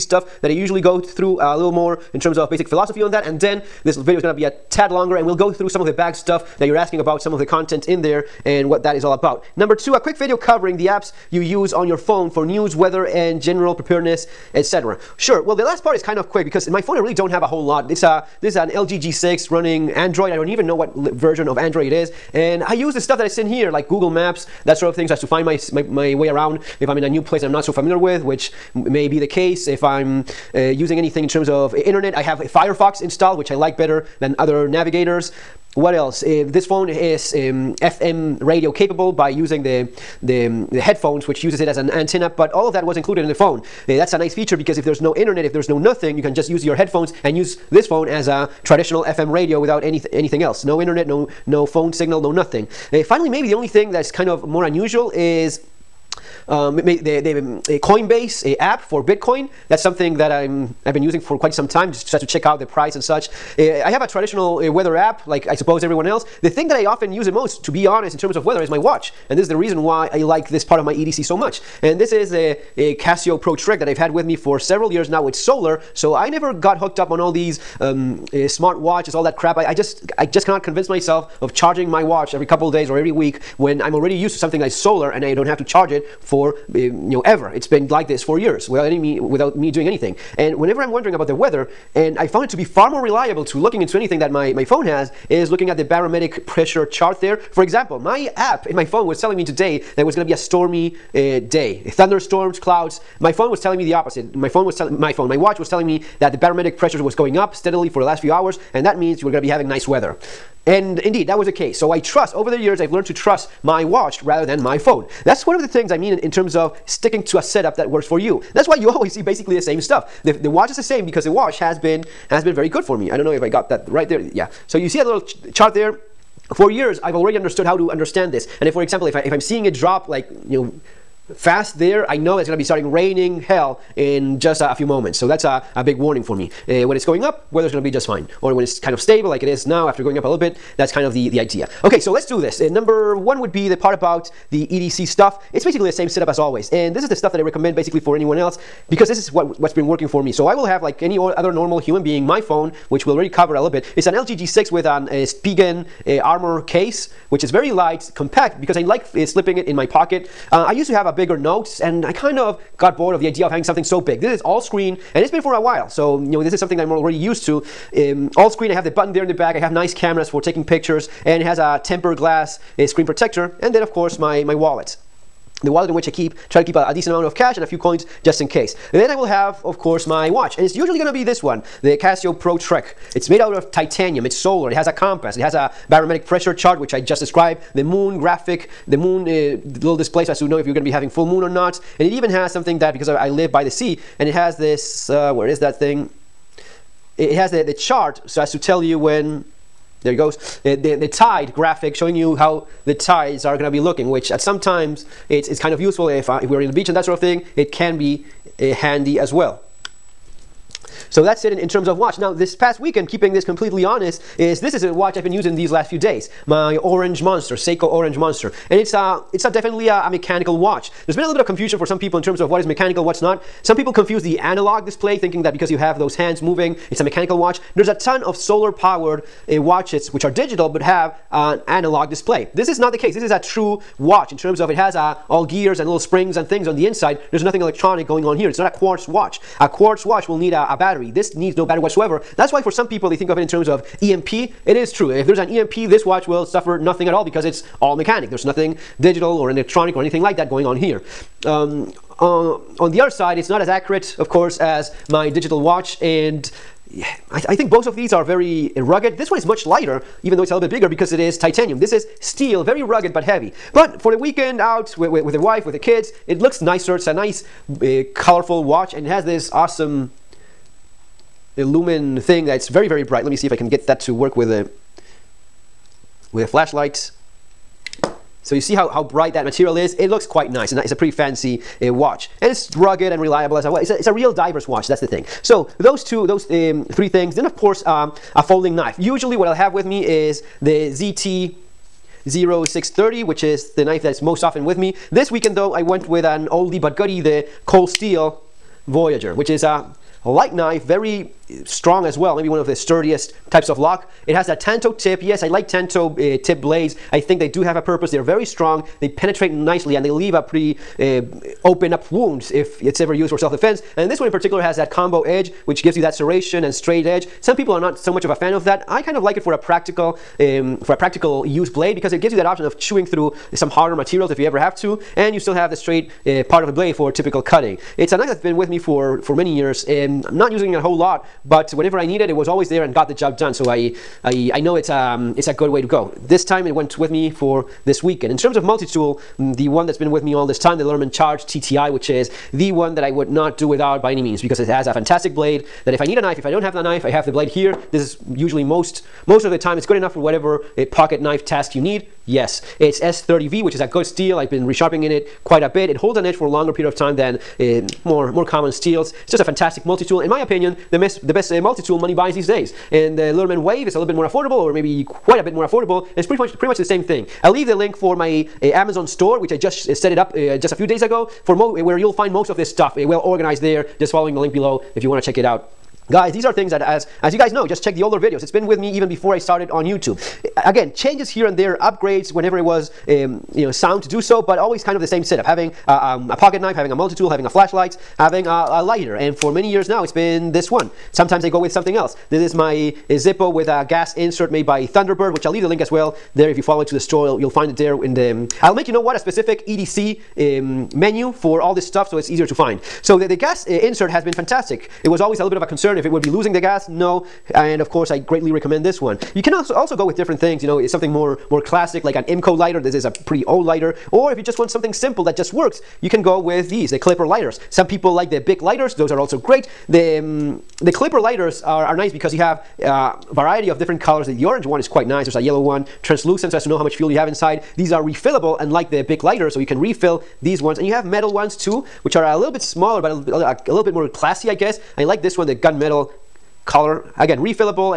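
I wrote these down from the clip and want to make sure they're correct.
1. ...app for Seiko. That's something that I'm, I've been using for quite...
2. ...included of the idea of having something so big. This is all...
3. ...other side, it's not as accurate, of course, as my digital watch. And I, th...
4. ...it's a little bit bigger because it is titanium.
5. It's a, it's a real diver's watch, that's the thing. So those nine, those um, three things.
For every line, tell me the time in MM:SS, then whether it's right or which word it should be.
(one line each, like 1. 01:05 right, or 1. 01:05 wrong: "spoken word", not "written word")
1. 00:58 wrong: "Bitcoin", not "Seiko"
2. 02:42 wrong: "bored", not "included"
3. 04:13 right
4. 04:20 right
5. 04:43 wrong: "two", not "nine".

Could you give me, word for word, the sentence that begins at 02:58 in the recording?
Then I will have, of course, my watch, and it's usually gonna be this one, the Casio Pro Trek.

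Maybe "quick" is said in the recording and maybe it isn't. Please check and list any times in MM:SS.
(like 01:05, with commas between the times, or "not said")
00:09, 00:16.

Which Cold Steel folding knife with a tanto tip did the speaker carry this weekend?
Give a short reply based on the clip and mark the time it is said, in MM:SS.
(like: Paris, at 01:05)
Voyager, at 04:58.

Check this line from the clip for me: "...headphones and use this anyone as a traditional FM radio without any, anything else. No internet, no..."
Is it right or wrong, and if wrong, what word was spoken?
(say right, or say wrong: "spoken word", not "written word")
wrong: "phone", not "anyone".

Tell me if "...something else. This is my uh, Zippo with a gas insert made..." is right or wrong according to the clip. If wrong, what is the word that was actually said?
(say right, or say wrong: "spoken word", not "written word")
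right.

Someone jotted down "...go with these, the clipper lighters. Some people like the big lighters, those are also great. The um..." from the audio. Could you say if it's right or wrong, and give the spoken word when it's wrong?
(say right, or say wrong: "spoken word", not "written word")
right.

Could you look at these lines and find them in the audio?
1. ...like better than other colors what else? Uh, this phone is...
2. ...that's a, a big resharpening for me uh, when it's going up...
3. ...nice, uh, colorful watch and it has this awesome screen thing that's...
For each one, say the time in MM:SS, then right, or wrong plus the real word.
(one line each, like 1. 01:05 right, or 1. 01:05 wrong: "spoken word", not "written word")
1. 00:33 wrong: "navigators", not "colors"
2. 02:15 wrong: "warning", not "resharpening"
3. 04:27 wrong: "lumen", not "screen".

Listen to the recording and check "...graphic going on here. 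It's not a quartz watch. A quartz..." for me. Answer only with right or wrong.
wrong.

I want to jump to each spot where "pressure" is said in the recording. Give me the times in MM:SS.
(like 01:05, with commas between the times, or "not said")
01:36, 01:46, 03:06.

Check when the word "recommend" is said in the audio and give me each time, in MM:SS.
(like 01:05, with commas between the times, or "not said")
02:27, 06:48.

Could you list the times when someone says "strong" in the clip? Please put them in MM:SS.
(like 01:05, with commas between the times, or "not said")
05:01, 05:08.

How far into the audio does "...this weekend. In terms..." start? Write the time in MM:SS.
05:37.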